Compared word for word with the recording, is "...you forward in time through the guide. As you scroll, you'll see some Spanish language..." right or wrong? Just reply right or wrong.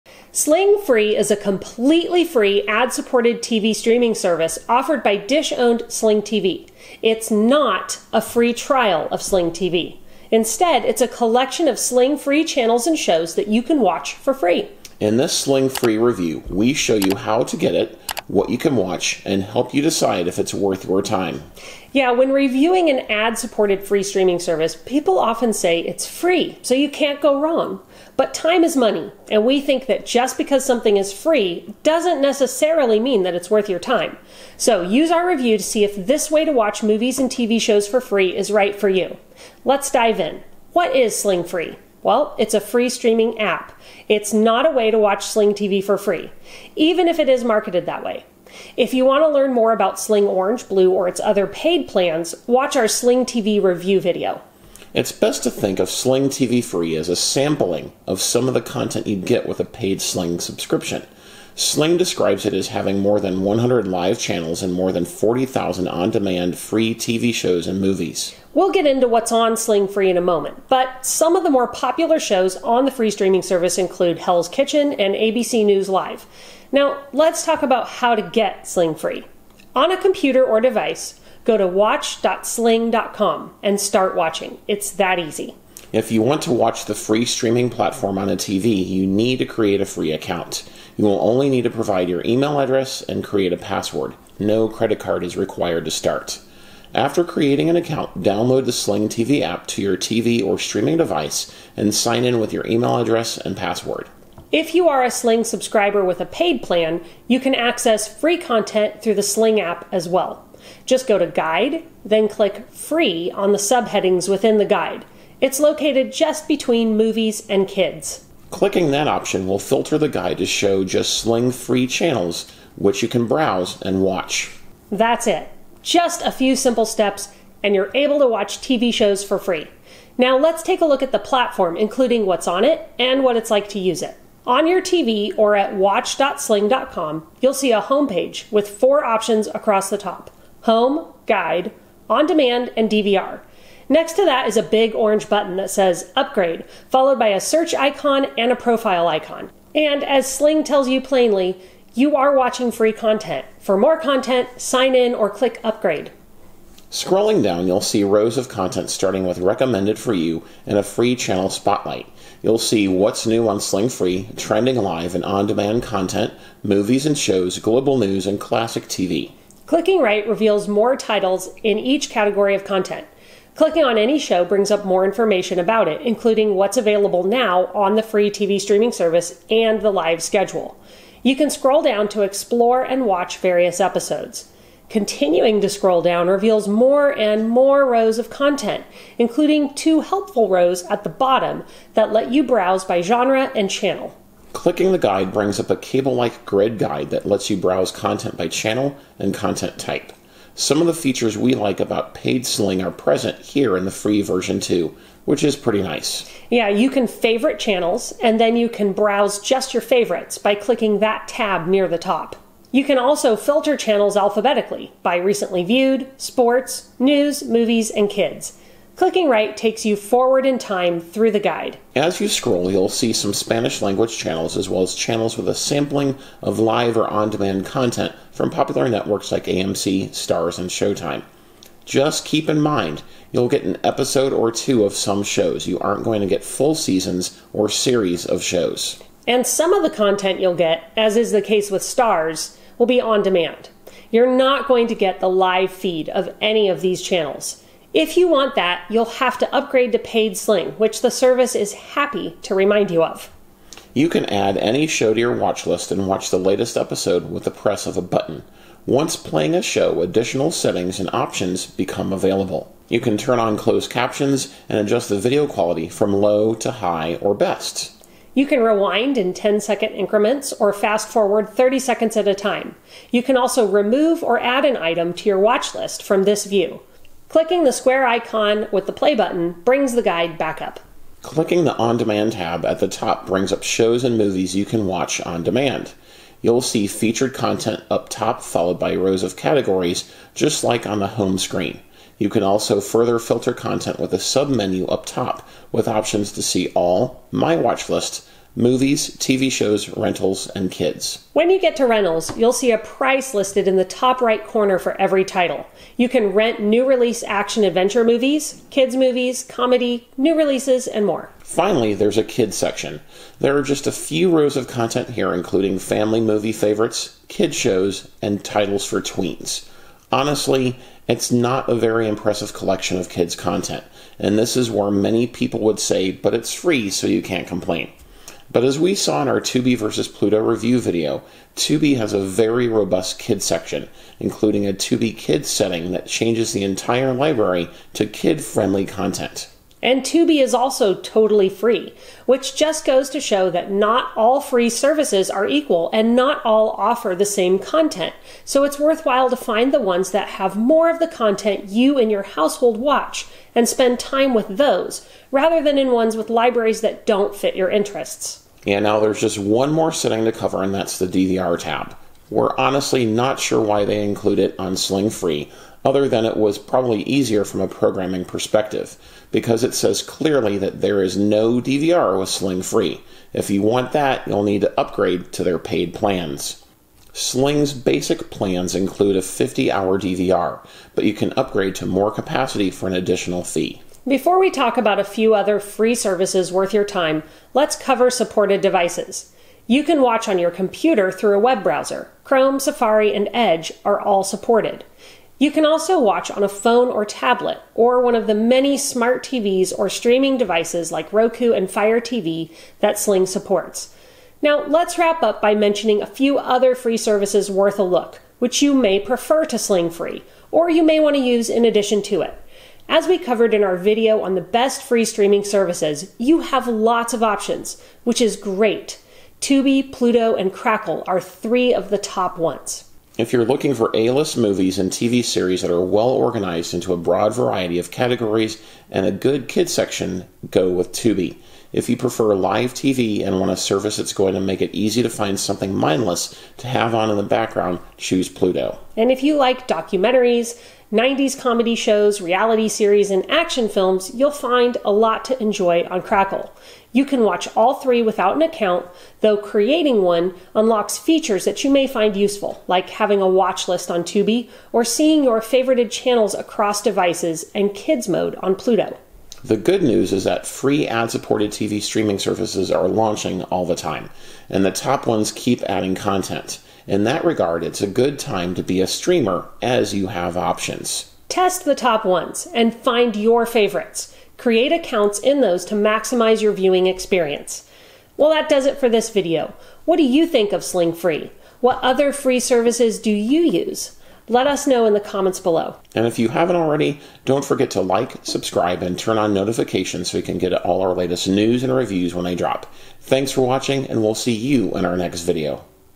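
right.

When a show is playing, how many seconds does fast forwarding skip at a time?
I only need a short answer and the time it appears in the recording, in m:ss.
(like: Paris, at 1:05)
30, at 4:31.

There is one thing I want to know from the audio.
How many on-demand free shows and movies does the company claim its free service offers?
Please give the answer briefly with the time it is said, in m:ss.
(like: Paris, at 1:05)
40,000, at 1:05.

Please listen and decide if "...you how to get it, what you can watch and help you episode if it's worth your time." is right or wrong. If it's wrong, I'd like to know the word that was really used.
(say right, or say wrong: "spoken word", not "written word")
wrong: "decide", not "episode".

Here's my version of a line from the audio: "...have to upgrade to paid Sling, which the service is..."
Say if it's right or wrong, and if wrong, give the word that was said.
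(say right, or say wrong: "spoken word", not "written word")
right.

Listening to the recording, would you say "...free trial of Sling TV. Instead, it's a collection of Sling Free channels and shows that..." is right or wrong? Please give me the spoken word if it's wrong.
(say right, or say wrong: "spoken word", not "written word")
right.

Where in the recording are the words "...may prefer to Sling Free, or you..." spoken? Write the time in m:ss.
6:48.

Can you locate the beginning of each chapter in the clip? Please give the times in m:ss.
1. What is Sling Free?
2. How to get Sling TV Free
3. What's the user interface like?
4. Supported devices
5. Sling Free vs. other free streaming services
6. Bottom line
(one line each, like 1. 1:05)
1. 0:39
2. 1:16
3. 2:09
4. 6:24
5. 6:44
6. 7:39.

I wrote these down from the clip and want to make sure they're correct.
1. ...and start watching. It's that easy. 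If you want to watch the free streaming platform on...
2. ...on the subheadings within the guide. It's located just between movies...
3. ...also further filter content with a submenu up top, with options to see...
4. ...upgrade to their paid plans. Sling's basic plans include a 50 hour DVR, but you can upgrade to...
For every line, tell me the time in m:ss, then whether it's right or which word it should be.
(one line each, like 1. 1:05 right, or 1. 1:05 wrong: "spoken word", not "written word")
1. 1:23 right
2. 1:53 right
3. 4:52 right
4. 6:14 right.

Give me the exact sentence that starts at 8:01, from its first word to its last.
What other free services do you use?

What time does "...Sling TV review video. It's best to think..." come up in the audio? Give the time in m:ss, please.
0:52.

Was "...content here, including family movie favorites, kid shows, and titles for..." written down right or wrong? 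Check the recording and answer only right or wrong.
right.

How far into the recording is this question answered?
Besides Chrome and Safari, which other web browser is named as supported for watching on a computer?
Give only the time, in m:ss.
6:33.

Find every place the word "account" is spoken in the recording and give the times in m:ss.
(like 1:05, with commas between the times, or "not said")
1:30, 1:37, 7:28, 7:54.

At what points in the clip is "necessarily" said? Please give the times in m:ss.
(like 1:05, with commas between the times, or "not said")
0:32.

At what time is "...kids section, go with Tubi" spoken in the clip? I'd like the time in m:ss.
7:09.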